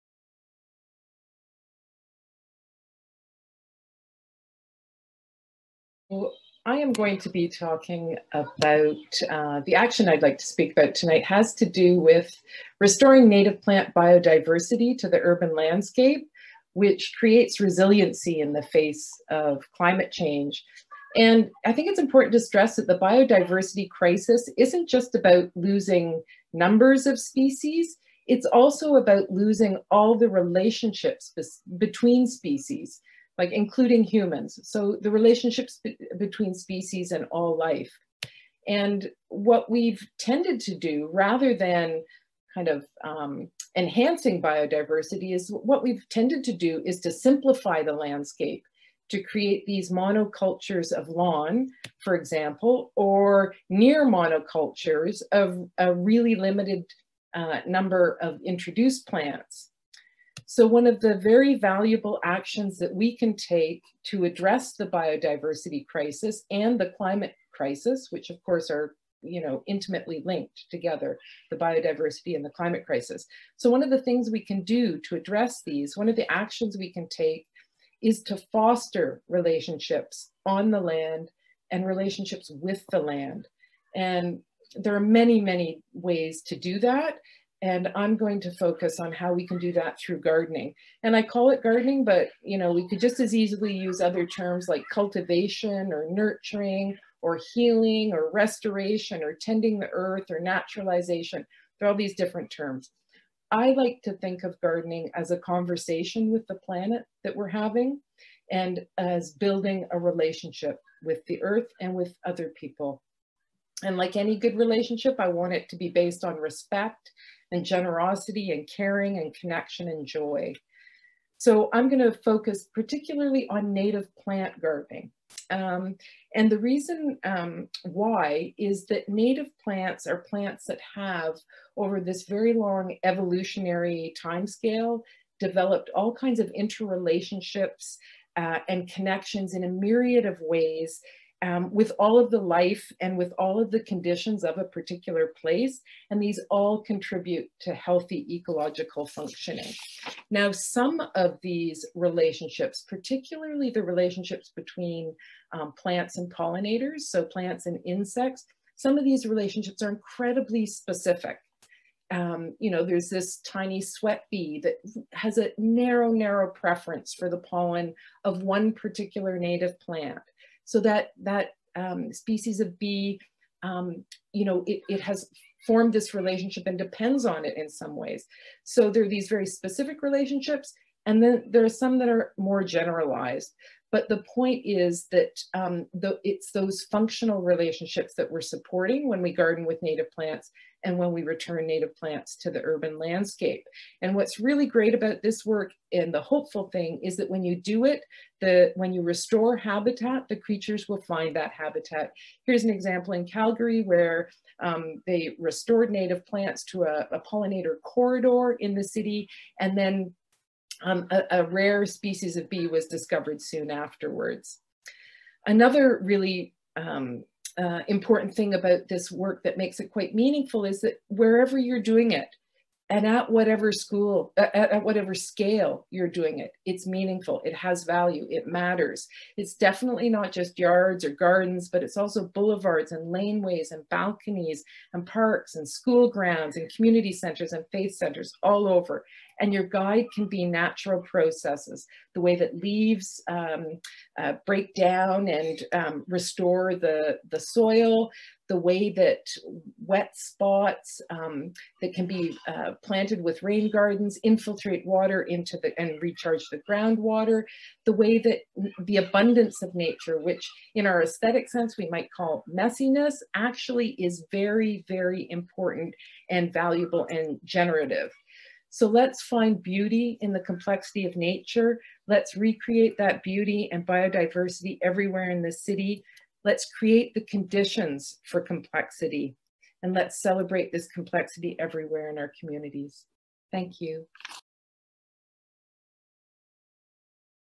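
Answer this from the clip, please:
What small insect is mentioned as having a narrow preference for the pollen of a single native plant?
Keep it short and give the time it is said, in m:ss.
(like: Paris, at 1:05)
sweat bee, at 2:43.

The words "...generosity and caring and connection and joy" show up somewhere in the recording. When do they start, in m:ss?
1:57.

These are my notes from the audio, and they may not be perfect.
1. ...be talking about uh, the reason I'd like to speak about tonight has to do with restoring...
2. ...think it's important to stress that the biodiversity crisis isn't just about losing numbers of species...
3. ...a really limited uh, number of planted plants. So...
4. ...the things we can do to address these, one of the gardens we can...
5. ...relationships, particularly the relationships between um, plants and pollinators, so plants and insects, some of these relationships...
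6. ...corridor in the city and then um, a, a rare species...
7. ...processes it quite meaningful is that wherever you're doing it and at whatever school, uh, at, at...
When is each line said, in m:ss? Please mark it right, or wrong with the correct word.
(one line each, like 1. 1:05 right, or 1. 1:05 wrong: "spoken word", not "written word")
1. 0:07 wrong: "action", not "reason"
2. 0:21 right
3. 0:55 wrong: "introduced", not "planted"
4. 1:13 wrong: "actions", not "gardens"
5. 2:31 right
6. 3:27 right
7. 3:39 wrong: "makes", not "processes".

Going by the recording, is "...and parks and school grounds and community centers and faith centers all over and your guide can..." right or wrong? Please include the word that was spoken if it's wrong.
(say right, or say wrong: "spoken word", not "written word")
right.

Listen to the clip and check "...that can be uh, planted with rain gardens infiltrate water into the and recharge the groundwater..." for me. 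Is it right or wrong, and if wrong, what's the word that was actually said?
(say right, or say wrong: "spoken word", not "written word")
right.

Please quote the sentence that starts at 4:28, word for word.
So let's find beauty in the complexity of nature.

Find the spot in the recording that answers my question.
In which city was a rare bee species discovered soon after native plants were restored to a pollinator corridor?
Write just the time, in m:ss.
3:23.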